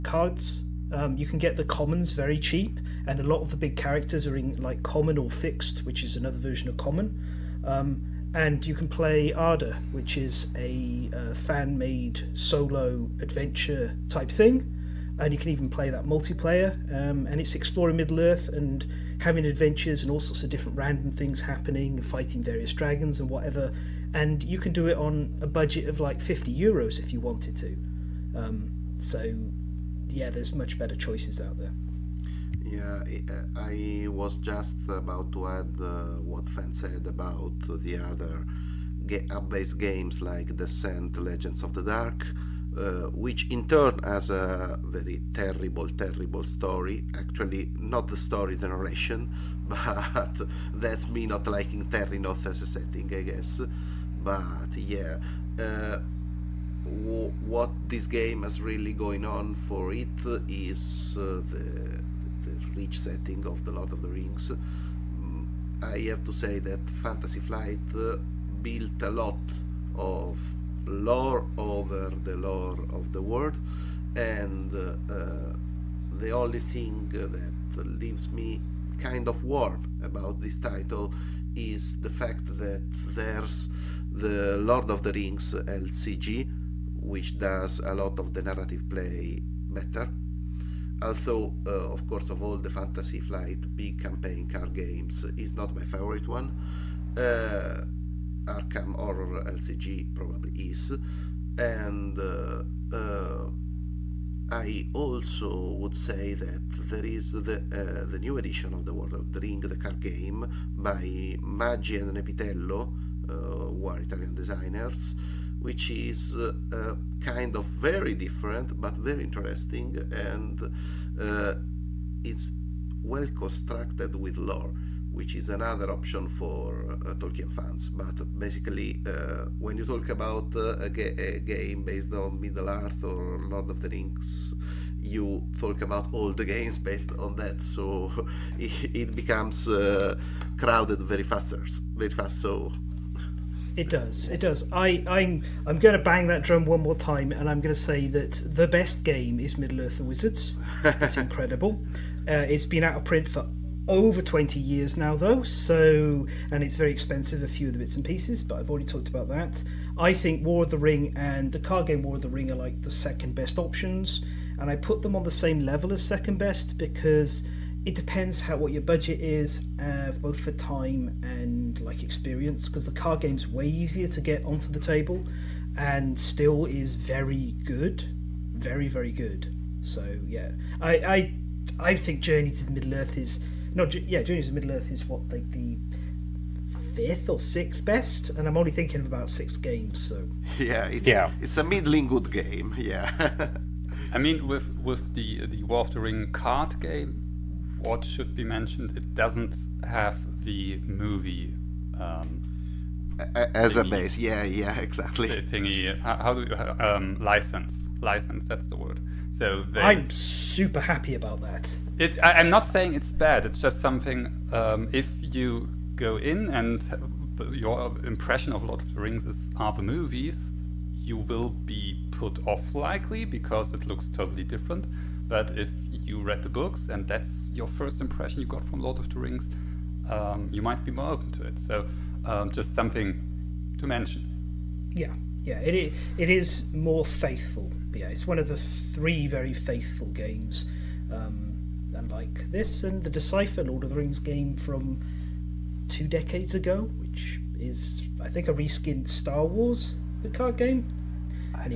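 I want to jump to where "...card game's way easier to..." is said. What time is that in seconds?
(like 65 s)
172 s.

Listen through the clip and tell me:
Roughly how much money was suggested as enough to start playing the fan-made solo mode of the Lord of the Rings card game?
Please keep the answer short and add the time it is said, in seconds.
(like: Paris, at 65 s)
50 euros, at 26 s.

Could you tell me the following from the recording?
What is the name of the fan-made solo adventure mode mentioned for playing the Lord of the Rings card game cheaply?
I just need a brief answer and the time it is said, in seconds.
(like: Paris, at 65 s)
Arda, at 9 s.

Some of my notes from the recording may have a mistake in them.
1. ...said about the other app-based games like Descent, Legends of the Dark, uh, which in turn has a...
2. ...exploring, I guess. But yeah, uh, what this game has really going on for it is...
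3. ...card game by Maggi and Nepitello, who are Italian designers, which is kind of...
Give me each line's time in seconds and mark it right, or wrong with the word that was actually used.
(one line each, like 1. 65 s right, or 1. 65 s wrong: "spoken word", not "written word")
1. 36 s right
2. 52 s wrong: "setting", not "exploring"
3. 109 s right.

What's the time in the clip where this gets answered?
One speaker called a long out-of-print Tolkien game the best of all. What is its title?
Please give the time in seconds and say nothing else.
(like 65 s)
149 s.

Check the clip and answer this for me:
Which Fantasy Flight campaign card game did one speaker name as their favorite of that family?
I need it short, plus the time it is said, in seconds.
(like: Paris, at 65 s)
Arkham Horror LCG, at 98 s.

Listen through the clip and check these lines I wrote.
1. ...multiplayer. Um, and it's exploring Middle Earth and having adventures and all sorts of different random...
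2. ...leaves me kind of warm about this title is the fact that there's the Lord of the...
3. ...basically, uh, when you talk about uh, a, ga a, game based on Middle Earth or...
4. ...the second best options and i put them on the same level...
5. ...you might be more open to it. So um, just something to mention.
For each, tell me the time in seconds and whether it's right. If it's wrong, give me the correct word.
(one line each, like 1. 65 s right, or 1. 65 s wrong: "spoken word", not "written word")
1. 16 s right
2. 78 s right
3. 128 s right
4. 162 s right
5. 230 s right.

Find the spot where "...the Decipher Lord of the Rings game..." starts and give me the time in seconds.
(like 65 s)
243 s.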